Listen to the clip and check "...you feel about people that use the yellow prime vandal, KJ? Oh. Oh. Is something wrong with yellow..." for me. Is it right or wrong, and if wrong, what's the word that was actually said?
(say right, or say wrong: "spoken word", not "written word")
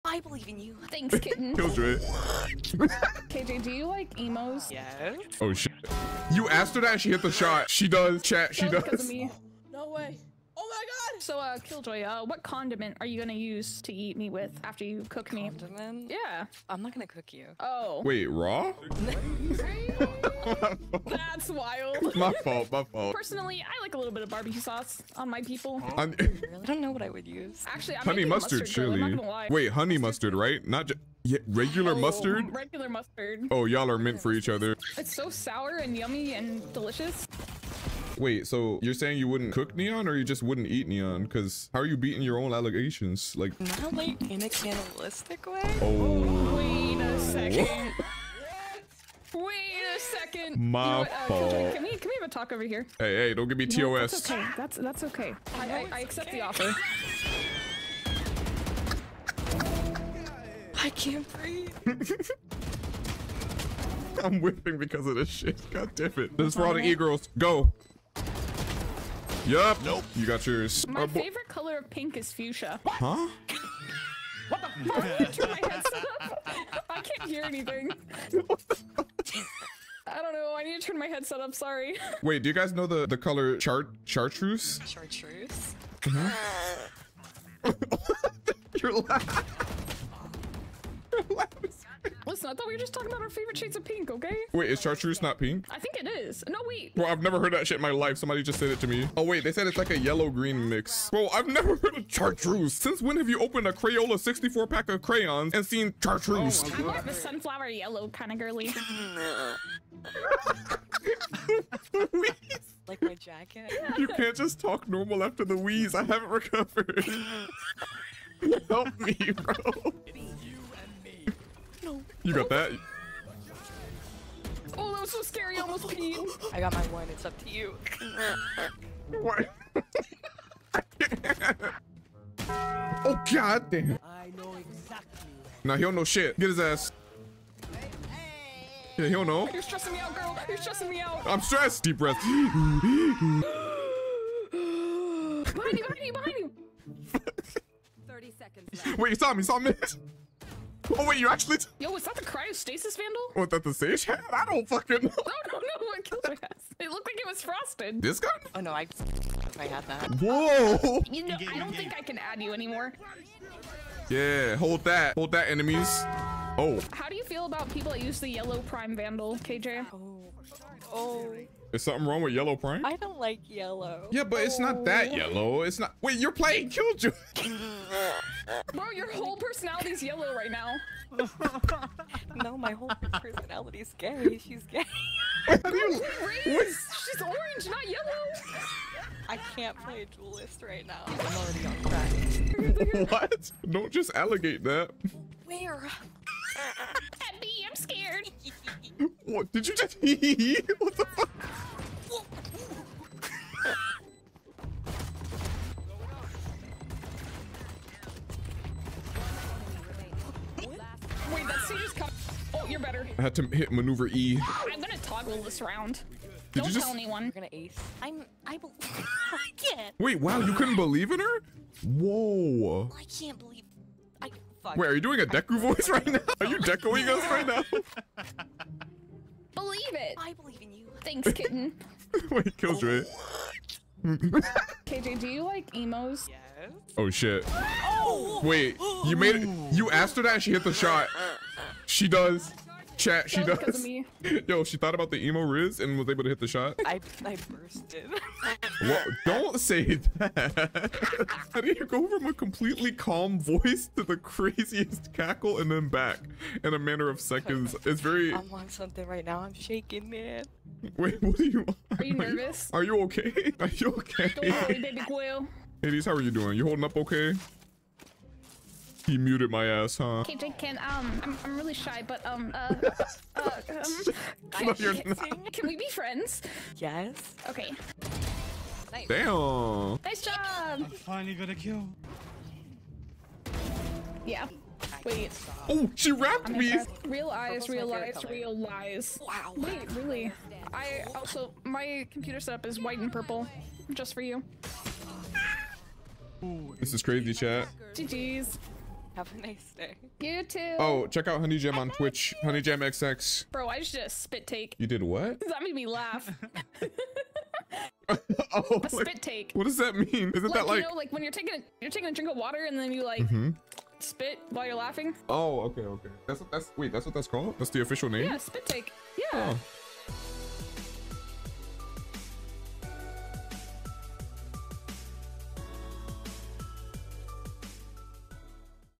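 right.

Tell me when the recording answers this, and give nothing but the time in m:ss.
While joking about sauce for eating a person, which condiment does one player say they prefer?
0:24.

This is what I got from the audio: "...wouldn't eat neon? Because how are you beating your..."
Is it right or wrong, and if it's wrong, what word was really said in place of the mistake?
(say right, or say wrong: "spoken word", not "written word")
right.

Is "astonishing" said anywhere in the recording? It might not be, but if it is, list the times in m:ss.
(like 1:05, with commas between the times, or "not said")
not said.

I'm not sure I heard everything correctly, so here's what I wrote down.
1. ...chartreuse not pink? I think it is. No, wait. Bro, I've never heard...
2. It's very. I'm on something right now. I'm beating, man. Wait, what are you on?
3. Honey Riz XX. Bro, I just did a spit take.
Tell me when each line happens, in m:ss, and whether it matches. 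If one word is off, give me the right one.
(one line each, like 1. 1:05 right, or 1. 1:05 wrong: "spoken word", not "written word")
1. 1:34 right
2. 4:17 wrong: "shaking", not "beating"
3. 5:02 wrong: "Jam", not "Riz".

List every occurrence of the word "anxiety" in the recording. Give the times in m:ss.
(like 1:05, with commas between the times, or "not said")
not said.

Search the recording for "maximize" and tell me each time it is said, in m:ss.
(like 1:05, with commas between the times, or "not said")
not said.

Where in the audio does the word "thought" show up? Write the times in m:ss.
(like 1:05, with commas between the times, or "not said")
1:32, 4:04.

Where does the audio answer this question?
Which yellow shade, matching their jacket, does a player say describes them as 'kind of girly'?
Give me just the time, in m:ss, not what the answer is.
1:47.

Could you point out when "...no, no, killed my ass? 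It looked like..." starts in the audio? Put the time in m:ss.
2:35.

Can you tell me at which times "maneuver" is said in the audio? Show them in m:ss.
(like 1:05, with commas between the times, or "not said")
3:33.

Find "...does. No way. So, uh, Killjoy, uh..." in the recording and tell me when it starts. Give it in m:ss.
0:08.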